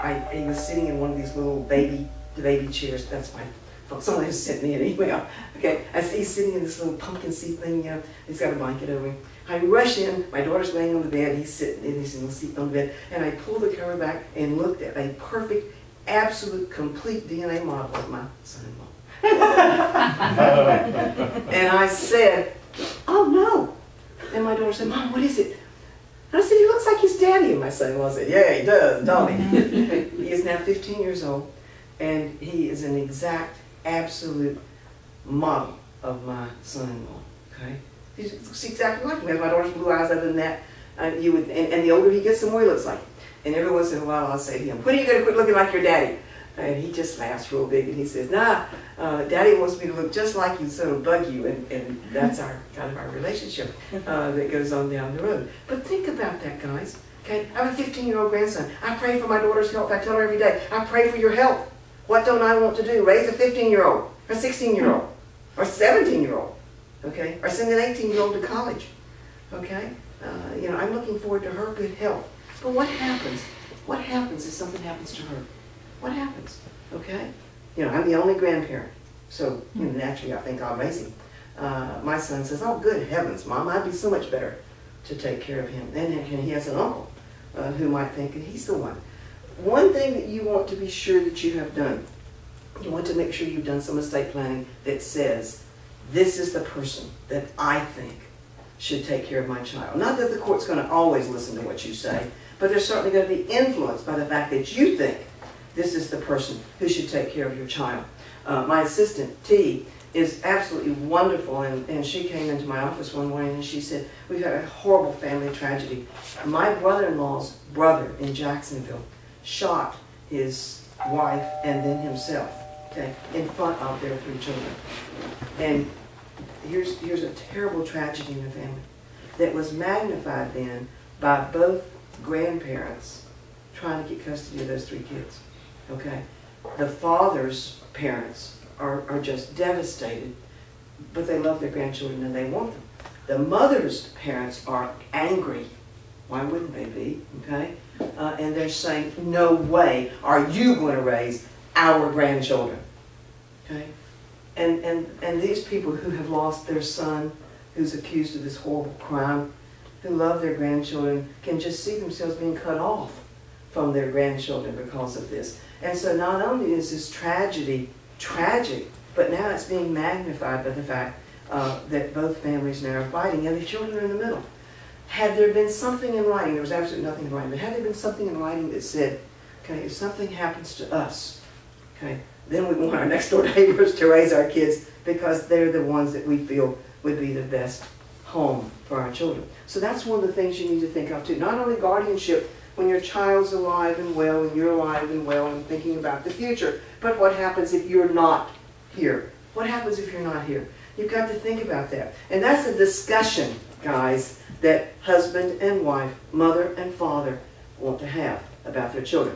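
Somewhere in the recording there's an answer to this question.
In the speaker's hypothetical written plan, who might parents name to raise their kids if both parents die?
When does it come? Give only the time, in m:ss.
3:03.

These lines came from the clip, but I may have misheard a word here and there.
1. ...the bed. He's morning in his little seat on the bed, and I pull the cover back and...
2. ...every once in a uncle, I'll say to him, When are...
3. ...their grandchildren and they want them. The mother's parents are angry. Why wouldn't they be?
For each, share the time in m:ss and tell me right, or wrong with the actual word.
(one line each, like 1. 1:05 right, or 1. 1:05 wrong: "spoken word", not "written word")
1. 0:11 wrong: "sitting", not "morning"
2. 0:43 wrong: "while", not "uncle"
3. 2:21 right.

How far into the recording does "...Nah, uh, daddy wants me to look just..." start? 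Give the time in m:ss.
0:48.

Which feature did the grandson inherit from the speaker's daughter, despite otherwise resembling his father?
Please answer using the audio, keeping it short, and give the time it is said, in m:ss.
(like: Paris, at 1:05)
blue eyes, at 0:39.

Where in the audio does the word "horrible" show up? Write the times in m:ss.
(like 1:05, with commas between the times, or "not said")
1:54, 2:38.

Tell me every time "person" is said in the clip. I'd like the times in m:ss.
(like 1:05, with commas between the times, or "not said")
1:36, 1:46.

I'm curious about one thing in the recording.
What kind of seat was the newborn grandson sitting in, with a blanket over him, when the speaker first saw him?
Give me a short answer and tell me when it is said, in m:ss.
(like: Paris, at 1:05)
pumpkin seat, at 0:06.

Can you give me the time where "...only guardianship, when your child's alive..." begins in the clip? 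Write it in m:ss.
3:11.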